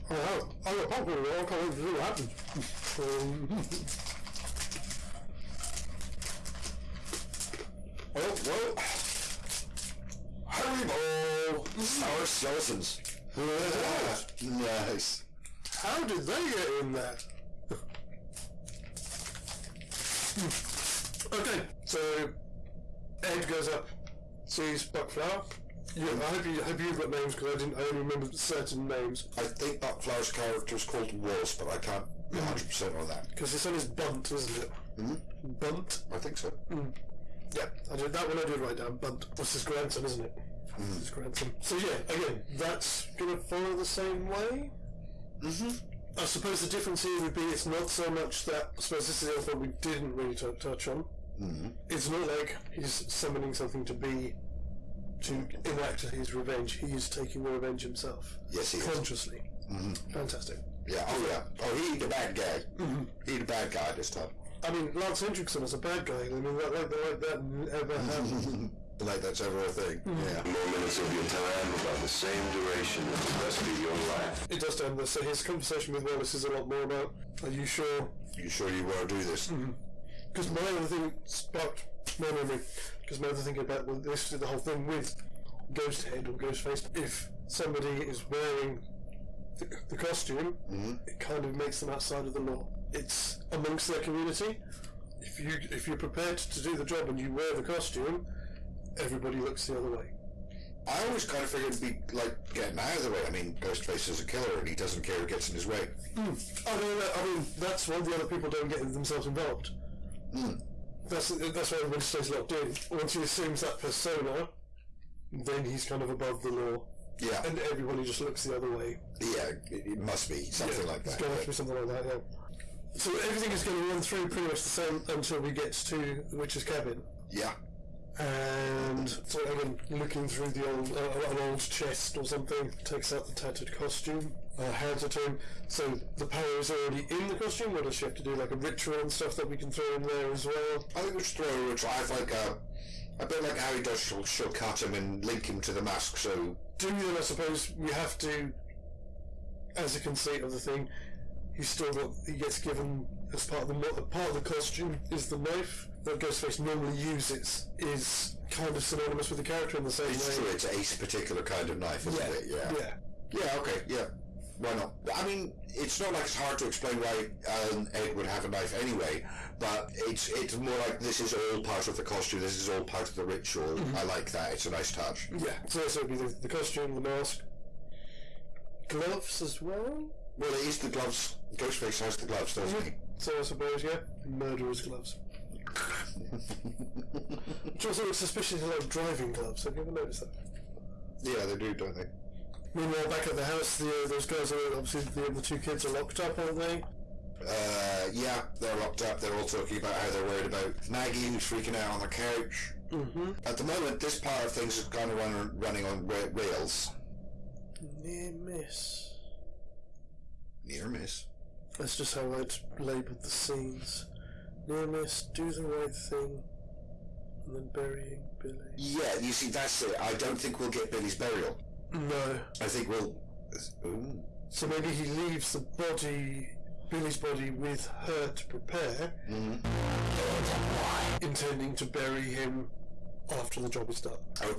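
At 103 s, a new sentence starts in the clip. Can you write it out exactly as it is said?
I mean, Ghostface is a killer and he doesn't care who gets in his way.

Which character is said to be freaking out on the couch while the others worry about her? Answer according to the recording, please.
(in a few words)
Maggie.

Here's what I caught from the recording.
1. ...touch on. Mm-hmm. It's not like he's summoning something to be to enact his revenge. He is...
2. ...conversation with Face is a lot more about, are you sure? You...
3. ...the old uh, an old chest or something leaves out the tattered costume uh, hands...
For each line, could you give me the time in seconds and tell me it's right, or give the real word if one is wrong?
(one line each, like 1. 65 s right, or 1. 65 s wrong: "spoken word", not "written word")
1. 50 s right
2. 75 s wrong: "Wallace", not "Face"
3. 130 s wrong: "takes", not "leaves".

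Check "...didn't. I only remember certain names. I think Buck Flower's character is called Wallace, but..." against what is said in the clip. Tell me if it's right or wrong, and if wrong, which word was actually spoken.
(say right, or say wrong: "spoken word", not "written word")
right.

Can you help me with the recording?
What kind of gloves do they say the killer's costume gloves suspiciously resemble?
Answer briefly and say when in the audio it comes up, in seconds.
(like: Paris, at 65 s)
Driving gloves, at 188 s.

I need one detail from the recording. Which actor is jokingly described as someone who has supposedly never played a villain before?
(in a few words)
Lance Henriksen.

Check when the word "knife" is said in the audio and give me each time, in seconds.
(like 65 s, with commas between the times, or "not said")
155 s, 161 s, 168 s.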